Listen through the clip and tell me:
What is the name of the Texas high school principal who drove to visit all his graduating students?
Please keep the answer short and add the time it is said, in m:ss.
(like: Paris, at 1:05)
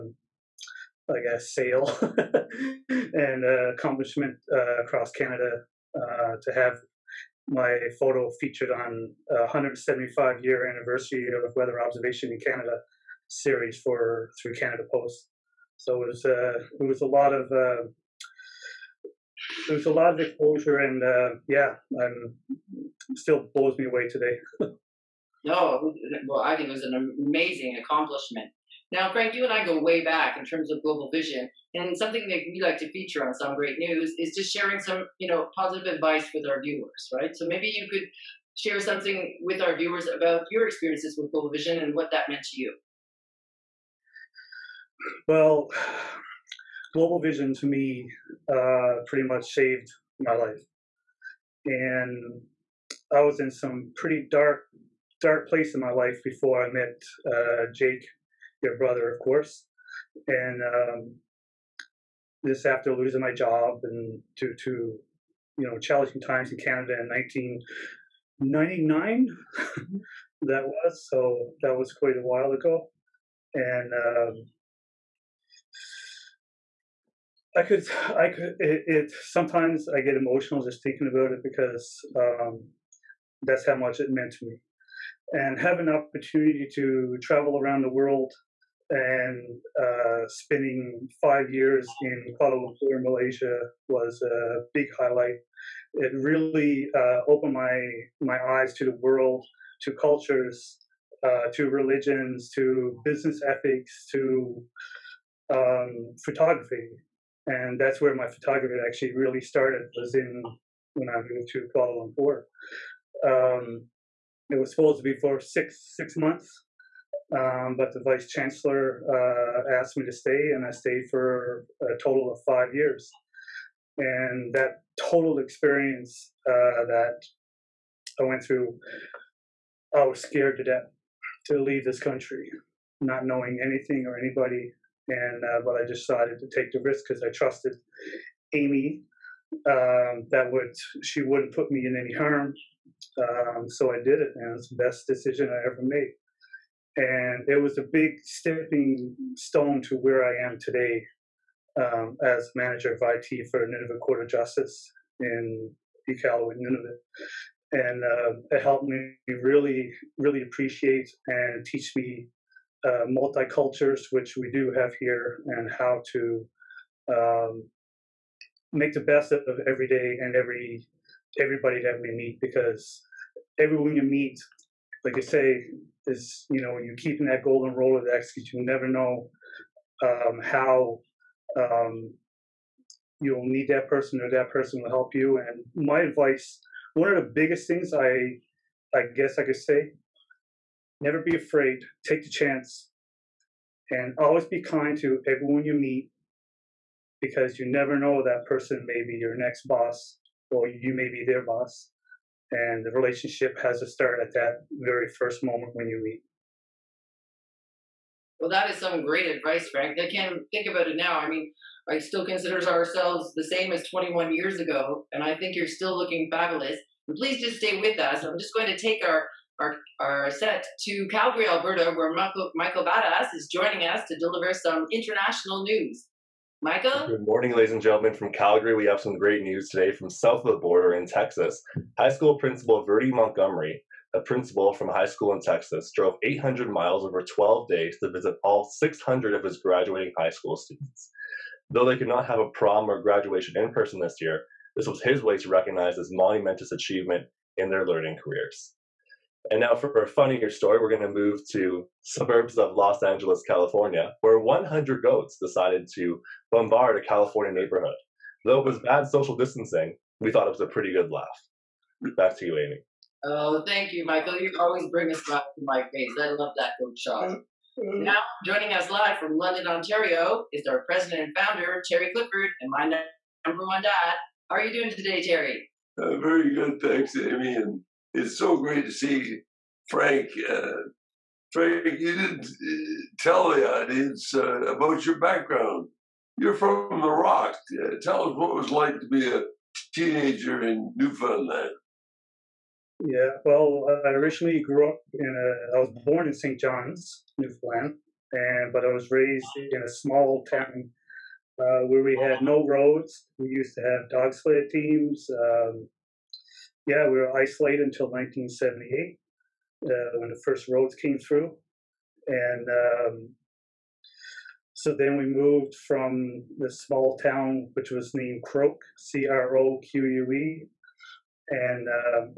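Virdie Montgomery, at 3:52.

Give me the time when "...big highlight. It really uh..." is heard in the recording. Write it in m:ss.
1:34.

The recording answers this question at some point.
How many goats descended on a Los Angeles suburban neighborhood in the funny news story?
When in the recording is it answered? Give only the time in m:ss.
4:14.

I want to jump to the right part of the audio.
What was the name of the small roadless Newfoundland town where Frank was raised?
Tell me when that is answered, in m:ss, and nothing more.
5:18.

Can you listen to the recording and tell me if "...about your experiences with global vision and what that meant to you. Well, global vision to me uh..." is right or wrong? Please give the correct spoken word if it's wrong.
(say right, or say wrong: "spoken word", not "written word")
right.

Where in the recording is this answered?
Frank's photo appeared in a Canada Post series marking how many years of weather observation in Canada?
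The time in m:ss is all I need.
0:09.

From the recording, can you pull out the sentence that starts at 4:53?
Yeah, well, I originally grew up in a.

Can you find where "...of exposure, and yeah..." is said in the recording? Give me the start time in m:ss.
0:20.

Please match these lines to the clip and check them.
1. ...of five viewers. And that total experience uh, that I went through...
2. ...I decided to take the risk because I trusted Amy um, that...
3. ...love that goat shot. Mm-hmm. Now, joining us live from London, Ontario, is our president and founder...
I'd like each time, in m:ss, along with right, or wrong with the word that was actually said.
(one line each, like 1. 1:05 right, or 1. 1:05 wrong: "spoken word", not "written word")
1. 2:02 wrong: "years", not "viewers"
2. 2:15 right
3. 4:26 right.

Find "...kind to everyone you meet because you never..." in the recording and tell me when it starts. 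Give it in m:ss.
3:14.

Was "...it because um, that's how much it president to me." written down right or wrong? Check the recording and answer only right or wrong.
wrong.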